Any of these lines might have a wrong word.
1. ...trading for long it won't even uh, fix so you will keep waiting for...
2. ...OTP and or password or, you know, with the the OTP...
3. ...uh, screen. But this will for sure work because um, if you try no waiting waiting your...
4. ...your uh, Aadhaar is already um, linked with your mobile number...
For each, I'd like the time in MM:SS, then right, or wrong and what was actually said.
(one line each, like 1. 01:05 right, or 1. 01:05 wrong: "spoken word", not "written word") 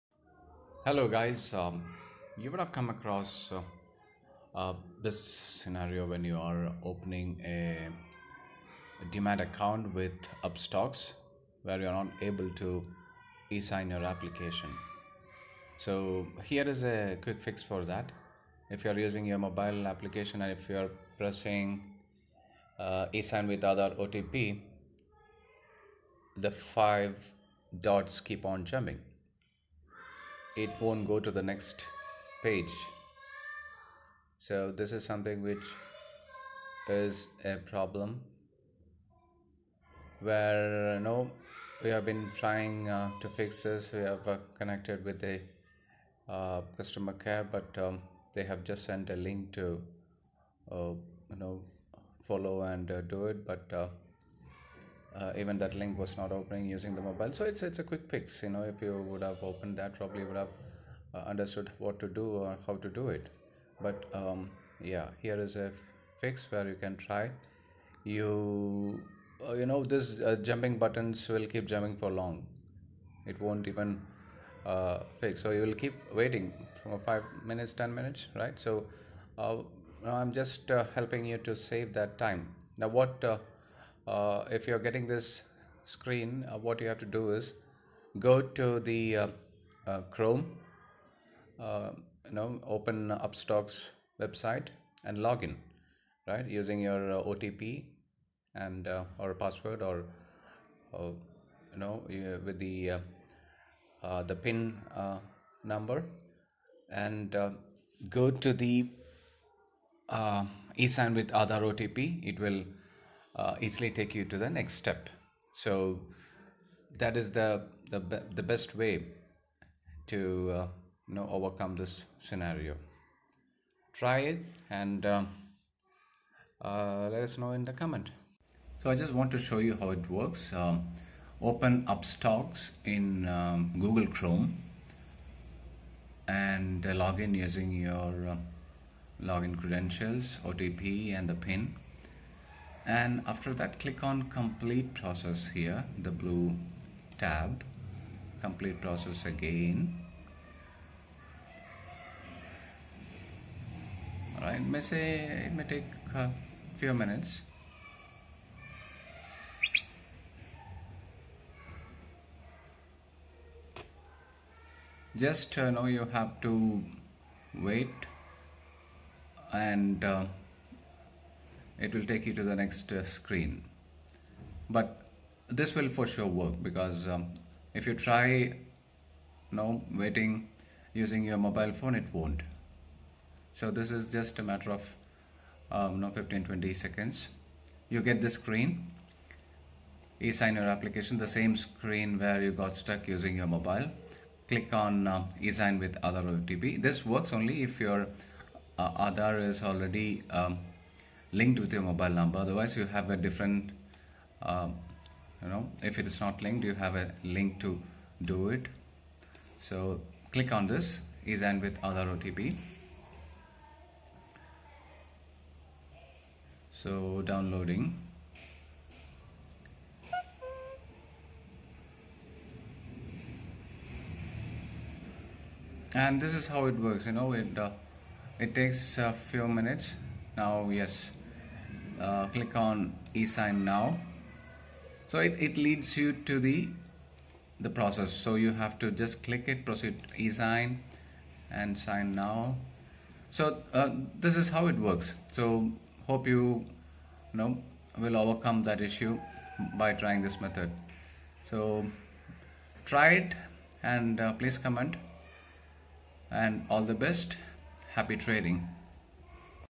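1. 01:11 wrong: "jumping", not "trading"
2. 01:37 wrong: "PIN", not "OTP"
3. 02:52 wrong: "using", not "waiting"
4. 03:17 right.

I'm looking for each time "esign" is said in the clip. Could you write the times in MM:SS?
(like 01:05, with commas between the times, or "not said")
03:53, 04:00.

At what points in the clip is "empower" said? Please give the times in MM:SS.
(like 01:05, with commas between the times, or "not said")
not said.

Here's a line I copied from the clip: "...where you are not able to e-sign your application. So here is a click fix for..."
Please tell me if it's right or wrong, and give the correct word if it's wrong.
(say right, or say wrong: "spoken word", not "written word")
wrong: "quick", not "click".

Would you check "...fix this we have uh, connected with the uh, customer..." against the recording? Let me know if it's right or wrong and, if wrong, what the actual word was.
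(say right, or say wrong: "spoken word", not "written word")
right.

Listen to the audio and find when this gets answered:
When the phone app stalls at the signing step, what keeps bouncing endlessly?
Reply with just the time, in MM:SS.
00:26.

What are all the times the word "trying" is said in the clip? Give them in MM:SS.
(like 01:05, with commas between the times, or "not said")
00:42, 04:09.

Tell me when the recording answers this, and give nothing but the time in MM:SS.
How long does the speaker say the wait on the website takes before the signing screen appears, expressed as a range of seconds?
03:06.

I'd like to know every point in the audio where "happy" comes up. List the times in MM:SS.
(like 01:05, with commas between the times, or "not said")
04:17.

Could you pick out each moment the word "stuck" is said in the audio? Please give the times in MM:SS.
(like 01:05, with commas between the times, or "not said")
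03:12.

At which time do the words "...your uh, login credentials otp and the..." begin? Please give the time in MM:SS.
02:17.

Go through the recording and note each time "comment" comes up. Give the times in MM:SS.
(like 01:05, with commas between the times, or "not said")
02:07, 04:14.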